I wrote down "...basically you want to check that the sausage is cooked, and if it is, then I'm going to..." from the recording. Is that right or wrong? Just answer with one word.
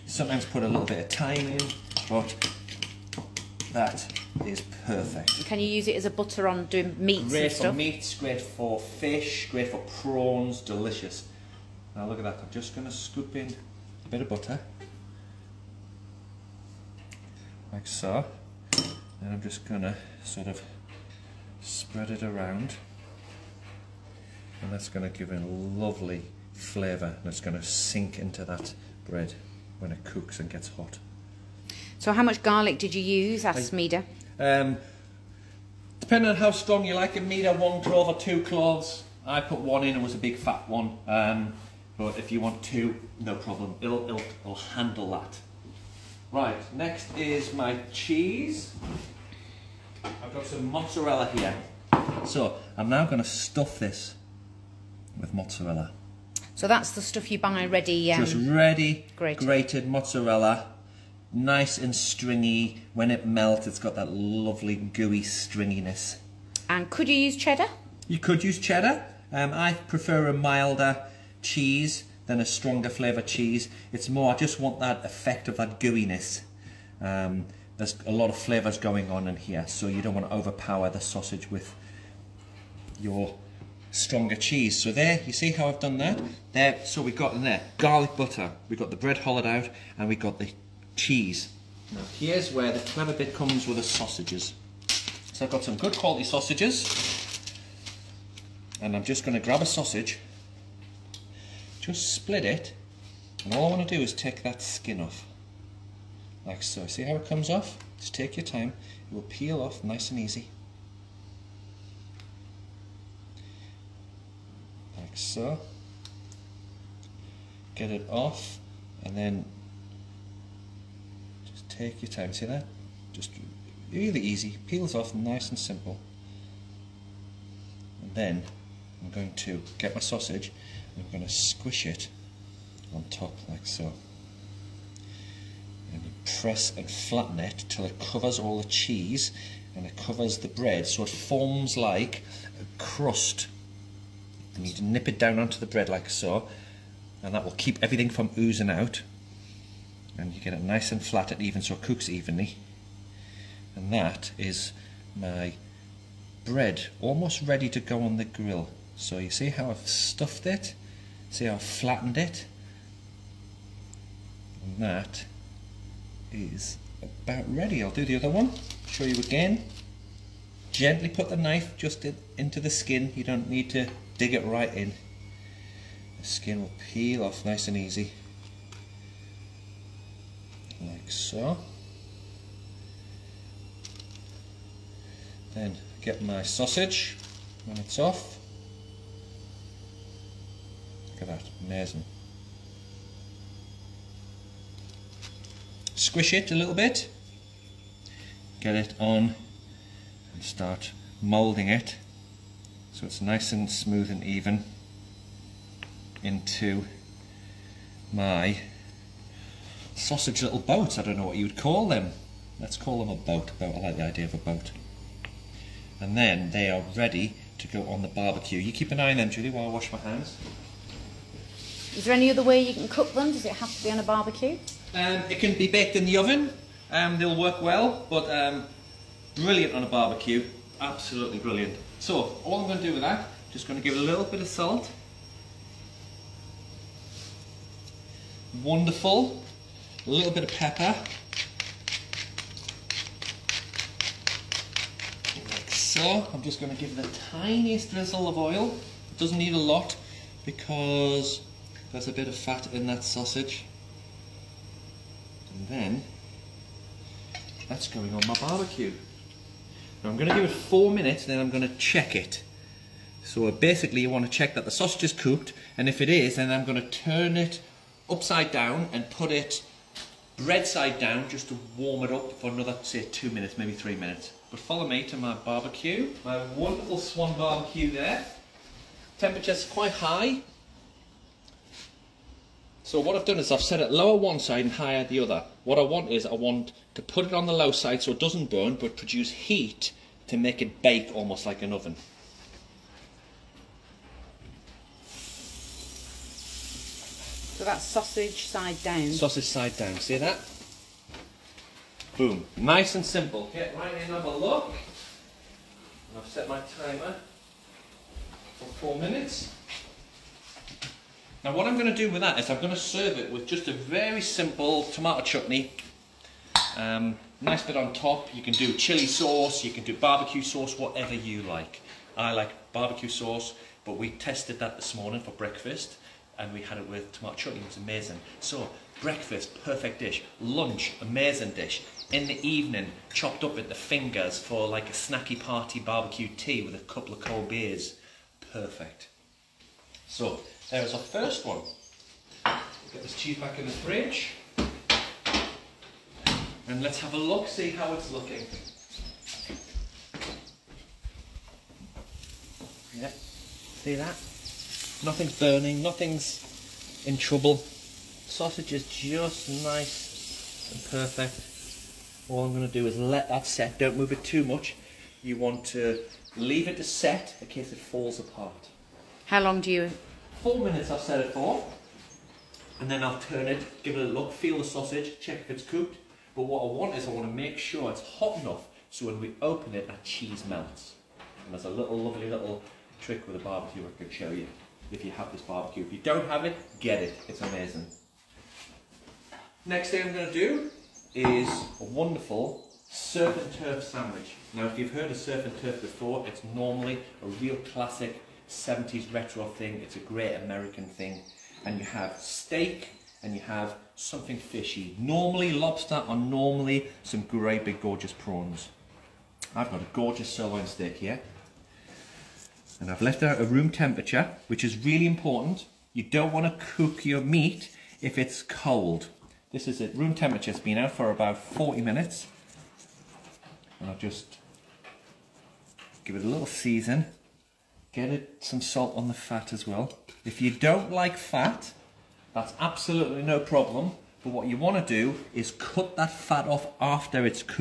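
right.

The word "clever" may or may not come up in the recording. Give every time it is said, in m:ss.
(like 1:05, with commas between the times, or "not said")
1:32.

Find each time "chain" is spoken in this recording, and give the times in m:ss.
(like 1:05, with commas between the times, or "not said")
not said.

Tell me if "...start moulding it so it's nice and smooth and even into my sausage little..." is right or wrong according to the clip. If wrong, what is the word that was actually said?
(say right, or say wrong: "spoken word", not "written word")
right.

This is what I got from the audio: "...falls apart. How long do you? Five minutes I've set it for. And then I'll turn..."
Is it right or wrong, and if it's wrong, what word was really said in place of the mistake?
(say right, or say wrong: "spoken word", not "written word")
wrong: "Four", not "Five".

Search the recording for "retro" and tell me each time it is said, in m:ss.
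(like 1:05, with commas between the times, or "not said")
6:39.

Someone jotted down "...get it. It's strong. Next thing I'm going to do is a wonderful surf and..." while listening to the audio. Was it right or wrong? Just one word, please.
wrong.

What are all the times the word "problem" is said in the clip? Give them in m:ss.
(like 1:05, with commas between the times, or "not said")
0:43, 7:13.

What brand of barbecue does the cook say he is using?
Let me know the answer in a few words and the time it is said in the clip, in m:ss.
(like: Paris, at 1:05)
Swan, at 4:36.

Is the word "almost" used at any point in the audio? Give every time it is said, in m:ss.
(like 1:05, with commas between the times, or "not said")
2:36, 4:51.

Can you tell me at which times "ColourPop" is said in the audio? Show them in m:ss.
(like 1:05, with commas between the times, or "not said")
not said.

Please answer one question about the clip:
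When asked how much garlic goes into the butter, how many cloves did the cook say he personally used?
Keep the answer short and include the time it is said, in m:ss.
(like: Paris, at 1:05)
1, at 0:39.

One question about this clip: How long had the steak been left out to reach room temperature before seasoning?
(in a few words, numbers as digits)
About 40 minutes.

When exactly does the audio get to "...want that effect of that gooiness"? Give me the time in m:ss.
1:14.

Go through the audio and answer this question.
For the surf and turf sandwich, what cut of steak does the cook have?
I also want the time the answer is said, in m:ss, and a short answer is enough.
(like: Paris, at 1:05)
Sirloin, at 6:50.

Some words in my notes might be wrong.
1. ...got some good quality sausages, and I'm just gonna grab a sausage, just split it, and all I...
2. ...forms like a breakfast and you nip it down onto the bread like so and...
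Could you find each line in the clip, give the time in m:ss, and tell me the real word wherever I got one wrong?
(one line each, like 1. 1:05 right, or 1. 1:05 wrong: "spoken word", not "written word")
1. 1:35 right
2. 2:21 wrong: "crust", not "breakfast".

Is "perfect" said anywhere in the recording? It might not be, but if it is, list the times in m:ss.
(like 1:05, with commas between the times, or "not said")
0:04, 5:29, 5:38, 6:00.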